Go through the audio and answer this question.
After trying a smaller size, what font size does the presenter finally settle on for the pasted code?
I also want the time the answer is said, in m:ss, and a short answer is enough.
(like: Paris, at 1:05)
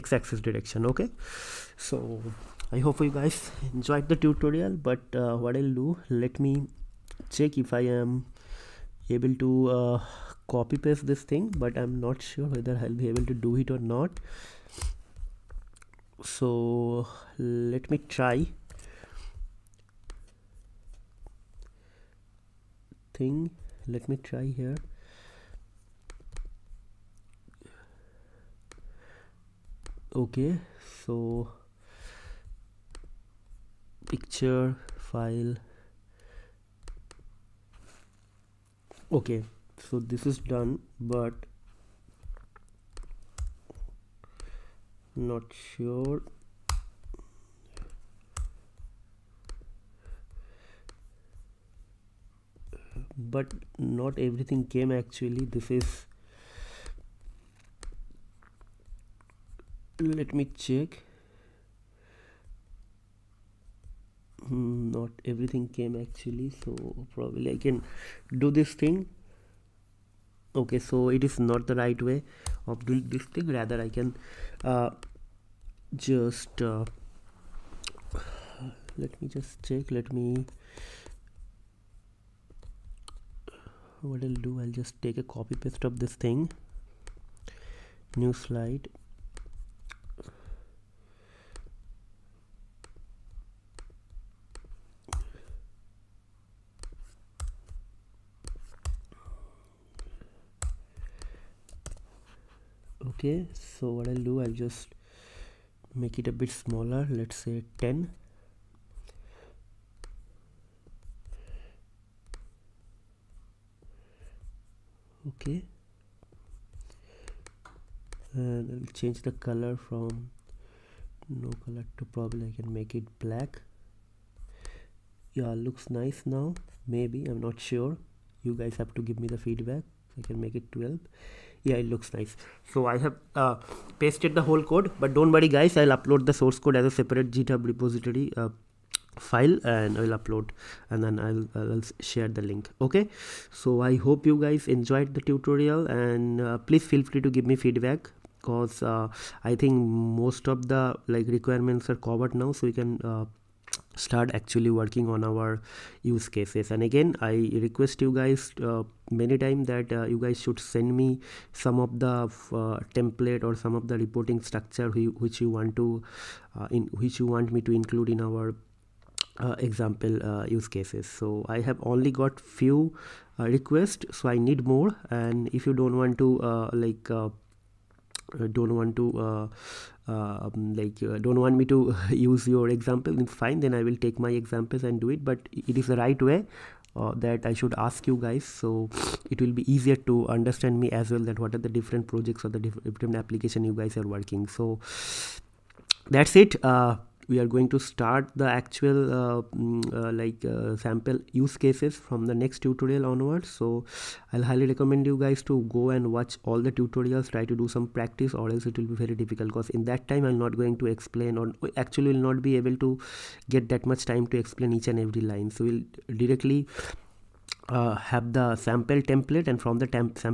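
12, at 2:10.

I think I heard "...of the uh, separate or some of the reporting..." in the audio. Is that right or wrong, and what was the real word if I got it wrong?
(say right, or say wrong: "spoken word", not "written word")
wrong: "template", not "separate".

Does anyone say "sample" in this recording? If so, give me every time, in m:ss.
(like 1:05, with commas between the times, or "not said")
3:20, 3:38.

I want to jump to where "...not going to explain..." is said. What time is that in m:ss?
3:30.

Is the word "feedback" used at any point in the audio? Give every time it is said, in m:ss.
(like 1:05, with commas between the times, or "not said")
2:09, 2:27.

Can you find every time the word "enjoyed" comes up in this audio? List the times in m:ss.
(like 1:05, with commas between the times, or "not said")
0:03, 2:24.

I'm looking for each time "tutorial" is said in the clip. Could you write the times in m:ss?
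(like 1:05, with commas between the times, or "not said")
0:04, 2:25, 3:22, 3:26.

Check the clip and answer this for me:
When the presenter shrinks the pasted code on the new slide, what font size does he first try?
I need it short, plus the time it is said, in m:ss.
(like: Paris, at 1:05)
10, at 1:47.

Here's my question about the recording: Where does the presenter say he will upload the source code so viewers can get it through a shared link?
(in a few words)
GitHub repository.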